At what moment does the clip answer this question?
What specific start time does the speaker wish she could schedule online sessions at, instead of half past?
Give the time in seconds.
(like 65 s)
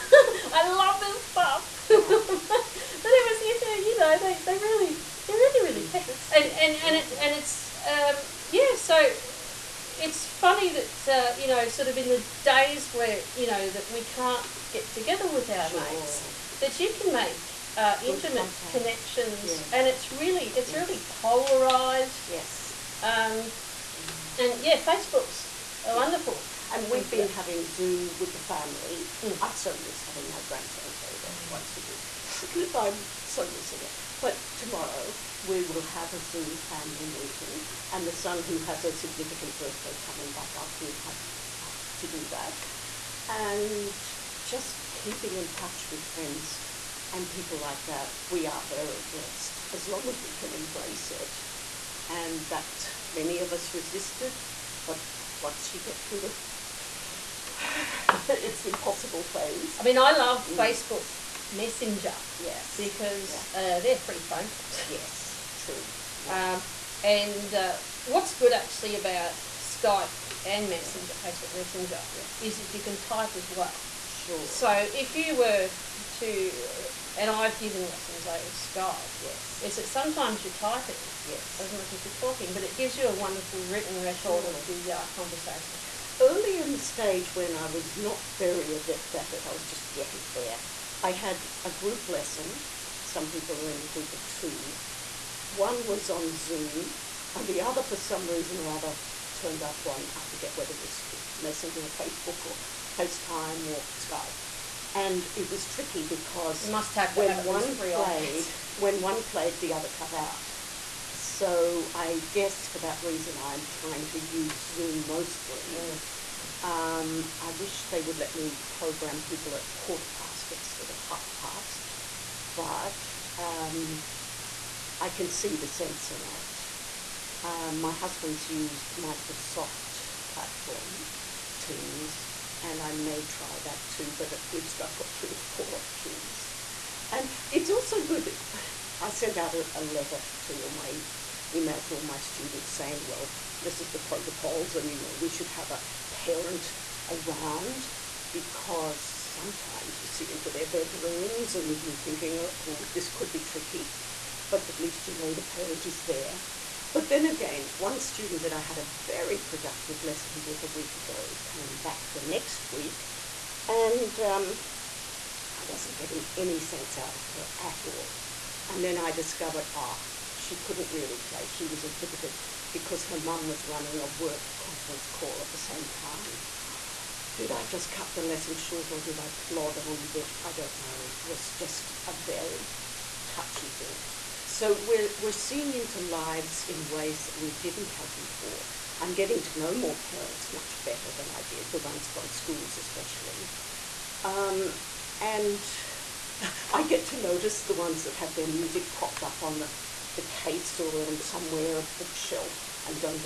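119 s.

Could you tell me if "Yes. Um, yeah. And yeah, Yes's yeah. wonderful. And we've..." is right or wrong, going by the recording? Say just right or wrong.
wrong.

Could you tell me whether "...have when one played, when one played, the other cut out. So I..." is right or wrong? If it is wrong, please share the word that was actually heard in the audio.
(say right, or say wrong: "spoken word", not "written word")
right.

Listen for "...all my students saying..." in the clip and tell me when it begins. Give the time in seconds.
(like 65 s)
141 s.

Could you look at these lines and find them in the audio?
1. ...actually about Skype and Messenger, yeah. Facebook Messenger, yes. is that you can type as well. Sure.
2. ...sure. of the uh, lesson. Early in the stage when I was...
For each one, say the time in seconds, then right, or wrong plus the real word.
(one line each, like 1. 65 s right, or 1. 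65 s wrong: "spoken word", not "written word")
1. 68 s right
2. 84 s wrong: "conversation", not "lesson".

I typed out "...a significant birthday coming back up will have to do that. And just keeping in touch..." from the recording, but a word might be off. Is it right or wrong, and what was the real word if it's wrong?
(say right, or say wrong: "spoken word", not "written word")
right.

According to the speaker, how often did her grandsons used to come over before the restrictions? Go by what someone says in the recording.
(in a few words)
once a week.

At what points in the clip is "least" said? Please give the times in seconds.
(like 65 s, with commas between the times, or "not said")
134 s, 154 s.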